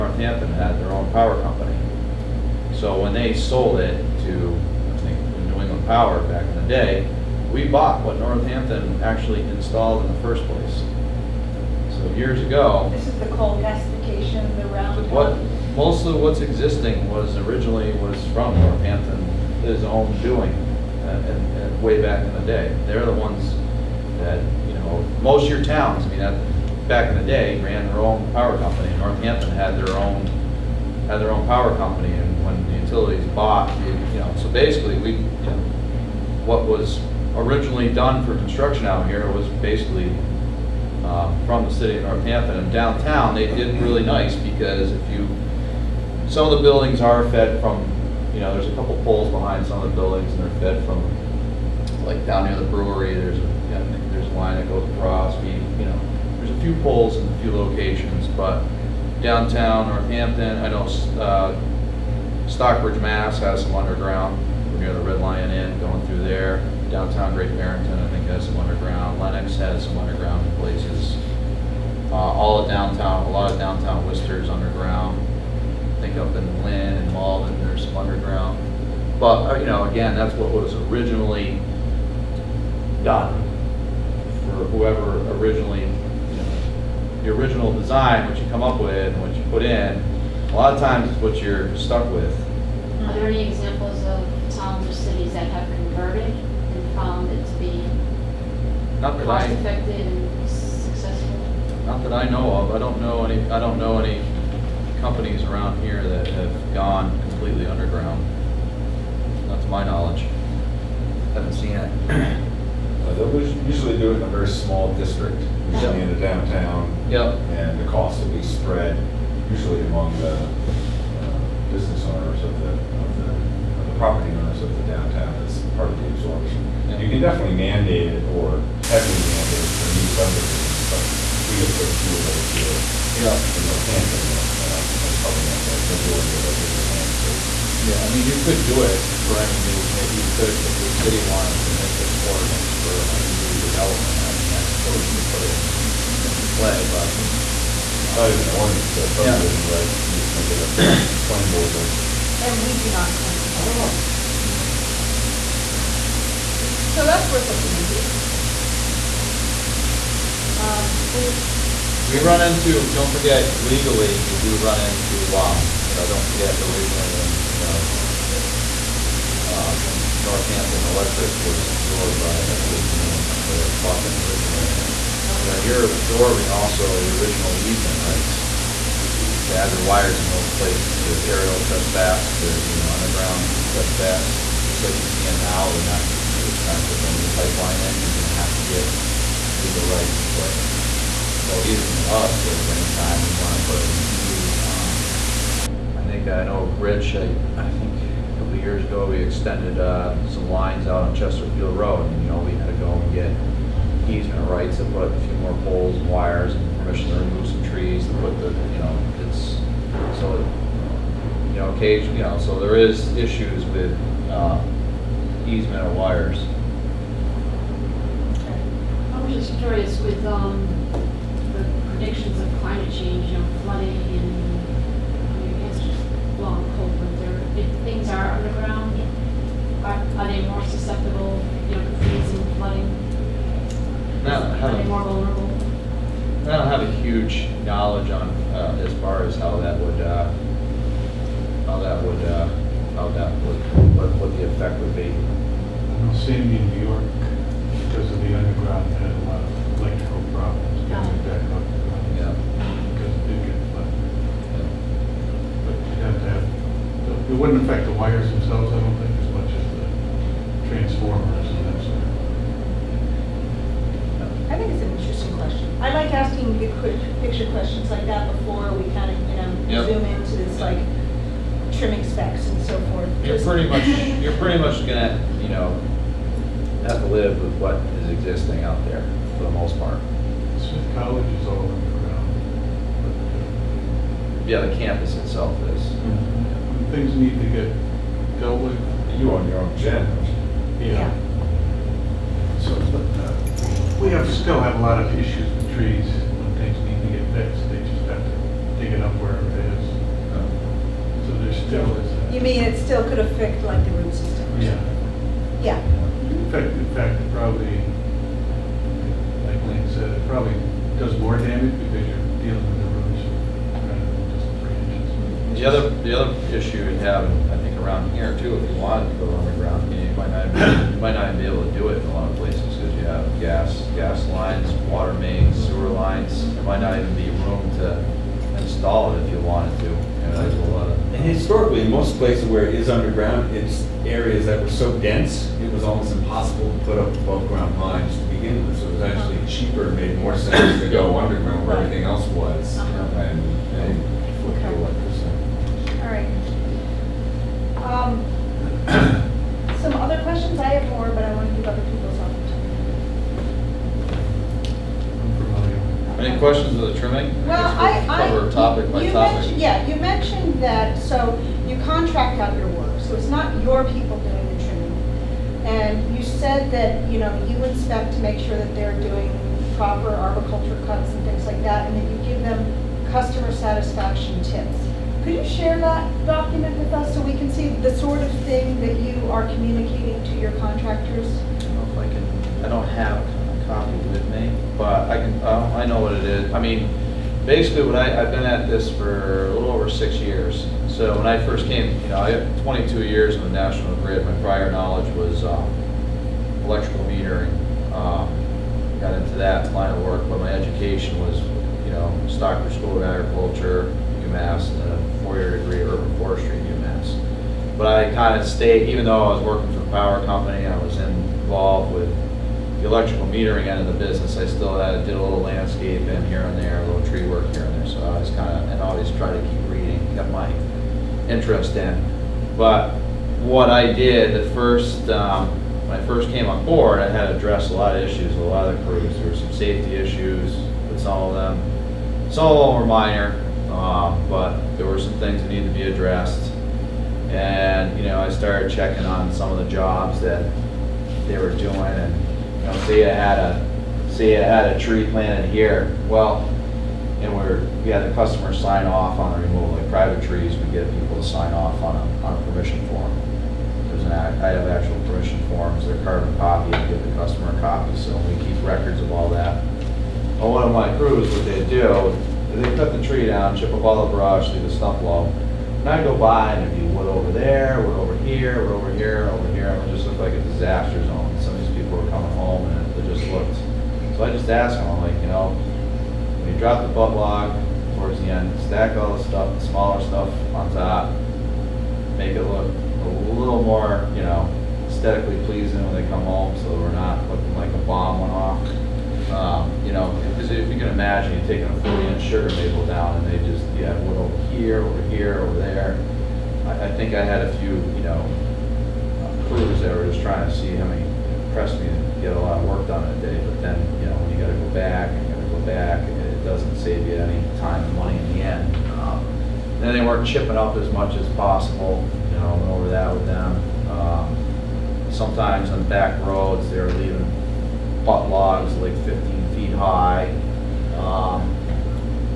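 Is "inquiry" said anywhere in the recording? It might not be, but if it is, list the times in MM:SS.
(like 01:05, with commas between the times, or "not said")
not said.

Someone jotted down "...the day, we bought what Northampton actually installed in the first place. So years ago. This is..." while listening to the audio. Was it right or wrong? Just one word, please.
right.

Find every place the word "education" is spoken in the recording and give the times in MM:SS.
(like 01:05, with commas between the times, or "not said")
06:40.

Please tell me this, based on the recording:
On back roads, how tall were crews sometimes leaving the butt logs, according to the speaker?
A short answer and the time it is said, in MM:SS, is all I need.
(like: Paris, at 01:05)
15 feet, at 08:39.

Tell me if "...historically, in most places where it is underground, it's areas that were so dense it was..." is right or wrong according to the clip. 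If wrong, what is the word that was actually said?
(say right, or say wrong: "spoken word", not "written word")
right.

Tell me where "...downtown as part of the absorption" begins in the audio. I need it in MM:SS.
02:04.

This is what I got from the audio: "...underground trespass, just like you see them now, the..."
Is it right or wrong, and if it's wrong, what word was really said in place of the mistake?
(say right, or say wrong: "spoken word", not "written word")
right.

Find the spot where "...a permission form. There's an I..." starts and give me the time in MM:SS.
07:32.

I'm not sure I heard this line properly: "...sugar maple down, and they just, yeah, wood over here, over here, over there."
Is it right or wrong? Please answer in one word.
right.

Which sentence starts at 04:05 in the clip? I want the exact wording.
I don't see any in New York because of the underground.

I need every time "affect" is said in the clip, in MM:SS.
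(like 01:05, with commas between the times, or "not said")
04:17, 05:03.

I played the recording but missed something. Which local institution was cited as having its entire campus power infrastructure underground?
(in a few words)
Smith College.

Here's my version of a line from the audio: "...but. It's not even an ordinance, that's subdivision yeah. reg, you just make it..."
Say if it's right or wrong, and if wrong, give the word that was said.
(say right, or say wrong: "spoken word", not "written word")
right.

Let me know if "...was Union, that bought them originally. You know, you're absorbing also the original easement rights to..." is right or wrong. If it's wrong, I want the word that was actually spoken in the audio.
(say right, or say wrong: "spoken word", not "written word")
right.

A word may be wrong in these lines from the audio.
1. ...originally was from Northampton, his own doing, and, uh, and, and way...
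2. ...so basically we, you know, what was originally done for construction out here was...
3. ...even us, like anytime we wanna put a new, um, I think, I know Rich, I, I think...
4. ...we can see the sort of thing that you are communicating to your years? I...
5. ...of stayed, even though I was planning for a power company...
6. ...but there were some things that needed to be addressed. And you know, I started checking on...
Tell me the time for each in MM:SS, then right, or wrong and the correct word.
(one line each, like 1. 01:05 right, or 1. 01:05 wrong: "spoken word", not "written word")
1. 00:17 right
2. 00:34 right
3. 03:11 right
4. 06:17 wrong: "contractors", not "years"
5. 06:48 wrong: "working", not "planning"
6. 07:14 right.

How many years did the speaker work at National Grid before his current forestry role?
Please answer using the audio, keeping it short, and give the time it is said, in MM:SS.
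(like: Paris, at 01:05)
22, at 06:32.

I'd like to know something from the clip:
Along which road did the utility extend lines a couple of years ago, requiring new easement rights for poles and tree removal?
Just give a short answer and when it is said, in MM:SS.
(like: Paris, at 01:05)
Chesterfield Road, at 03:21.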